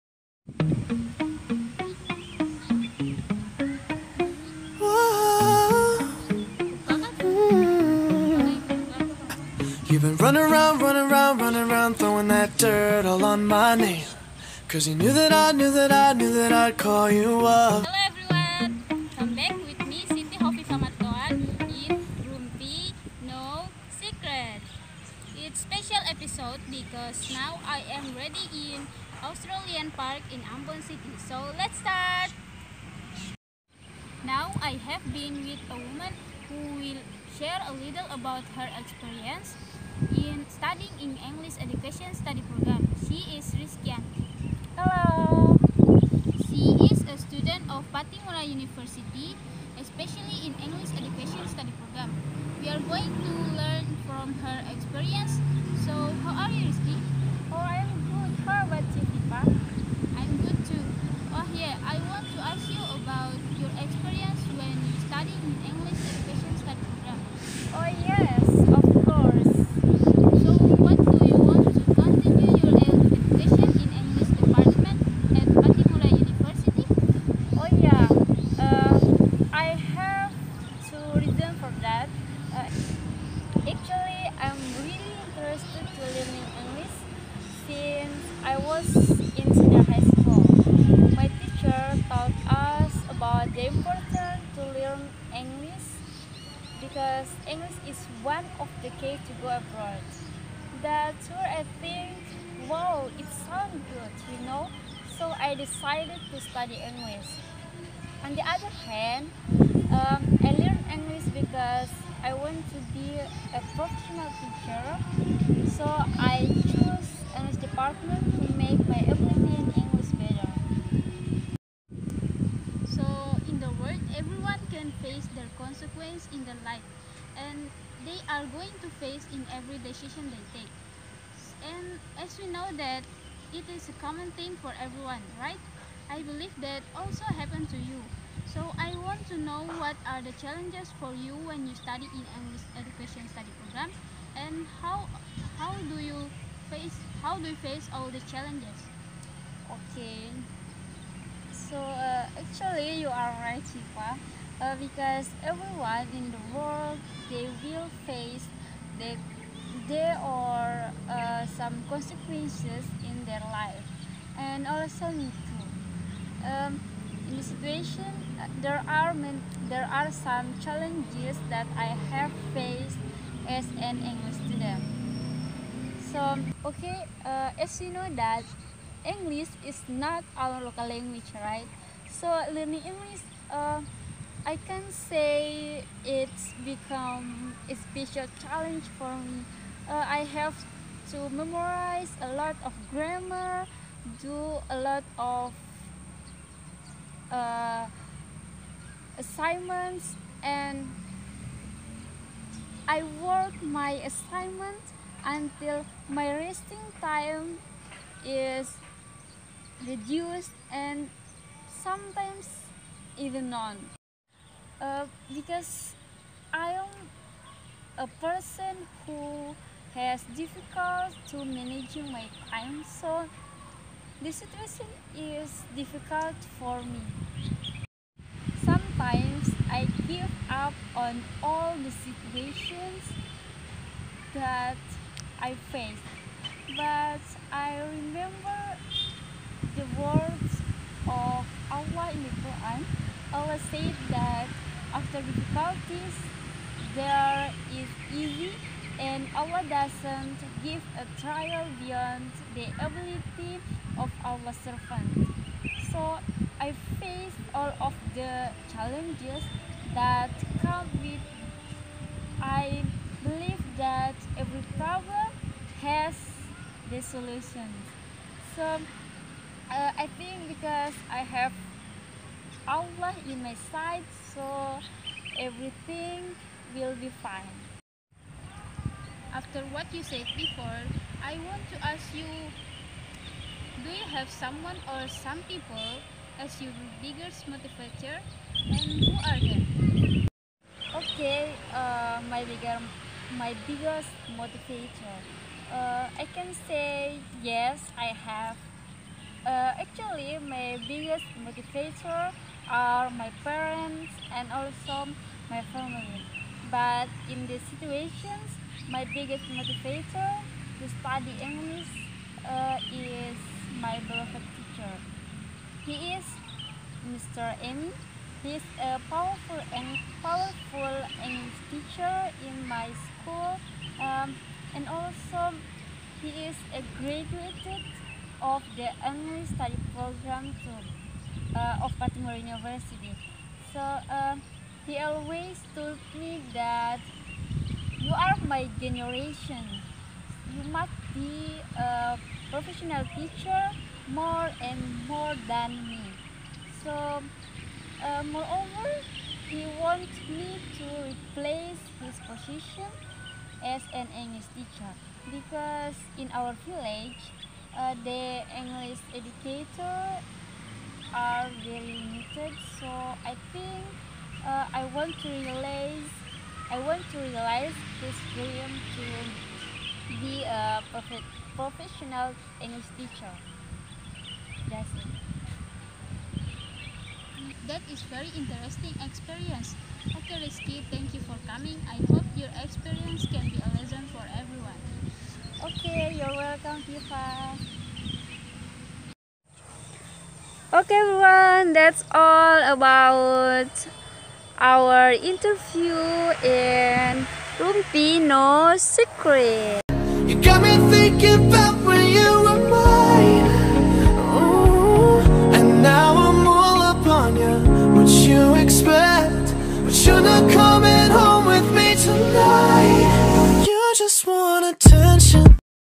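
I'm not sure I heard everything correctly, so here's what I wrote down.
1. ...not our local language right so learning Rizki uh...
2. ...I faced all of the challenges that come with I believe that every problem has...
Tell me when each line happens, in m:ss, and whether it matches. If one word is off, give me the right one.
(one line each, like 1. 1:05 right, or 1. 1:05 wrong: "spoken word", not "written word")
1. 2:59 wrong: "English", not "Rizki"
2. 4:16 right.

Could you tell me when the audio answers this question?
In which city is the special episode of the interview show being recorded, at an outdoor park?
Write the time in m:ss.
0:30.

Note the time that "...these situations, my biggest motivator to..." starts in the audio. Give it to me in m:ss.
5:07.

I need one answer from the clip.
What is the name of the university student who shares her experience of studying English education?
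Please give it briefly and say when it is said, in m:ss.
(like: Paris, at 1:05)
Rizki Yanti, at 0:43.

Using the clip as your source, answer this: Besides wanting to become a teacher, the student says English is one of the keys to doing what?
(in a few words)
Go abroad.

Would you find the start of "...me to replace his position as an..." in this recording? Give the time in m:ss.
5:50.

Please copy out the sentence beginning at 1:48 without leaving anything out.
On the other hand, um, I learned English because I want to be a professional teacher.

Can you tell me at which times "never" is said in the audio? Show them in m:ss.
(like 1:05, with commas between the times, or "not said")
not said.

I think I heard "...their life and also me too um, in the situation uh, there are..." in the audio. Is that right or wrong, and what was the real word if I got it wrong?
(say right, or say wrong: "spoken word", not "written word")
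right.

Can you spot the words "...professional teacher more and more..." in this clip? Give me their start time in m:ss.
5:42.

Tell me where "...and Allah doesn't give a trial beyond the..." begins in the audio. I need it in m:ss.
4:08.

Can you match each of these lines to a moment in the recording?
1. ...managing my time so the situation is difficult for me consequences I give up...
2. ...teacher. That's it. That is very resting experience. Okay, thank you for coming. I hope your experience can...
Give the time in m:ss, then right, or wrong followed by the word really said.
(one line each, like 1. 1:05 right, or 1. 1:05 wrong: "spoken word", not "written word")
1. 3:41 wrong: "sometimes", not "consequences"
2. 6:12 wrong: "interesting", not "resting".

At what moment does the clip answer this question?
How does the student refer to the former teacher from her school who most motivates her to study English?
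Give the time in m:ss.
5:17.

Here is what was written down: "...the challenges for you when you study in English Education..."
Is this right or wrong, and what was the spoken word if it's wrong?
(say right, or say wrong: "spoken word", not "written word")
right.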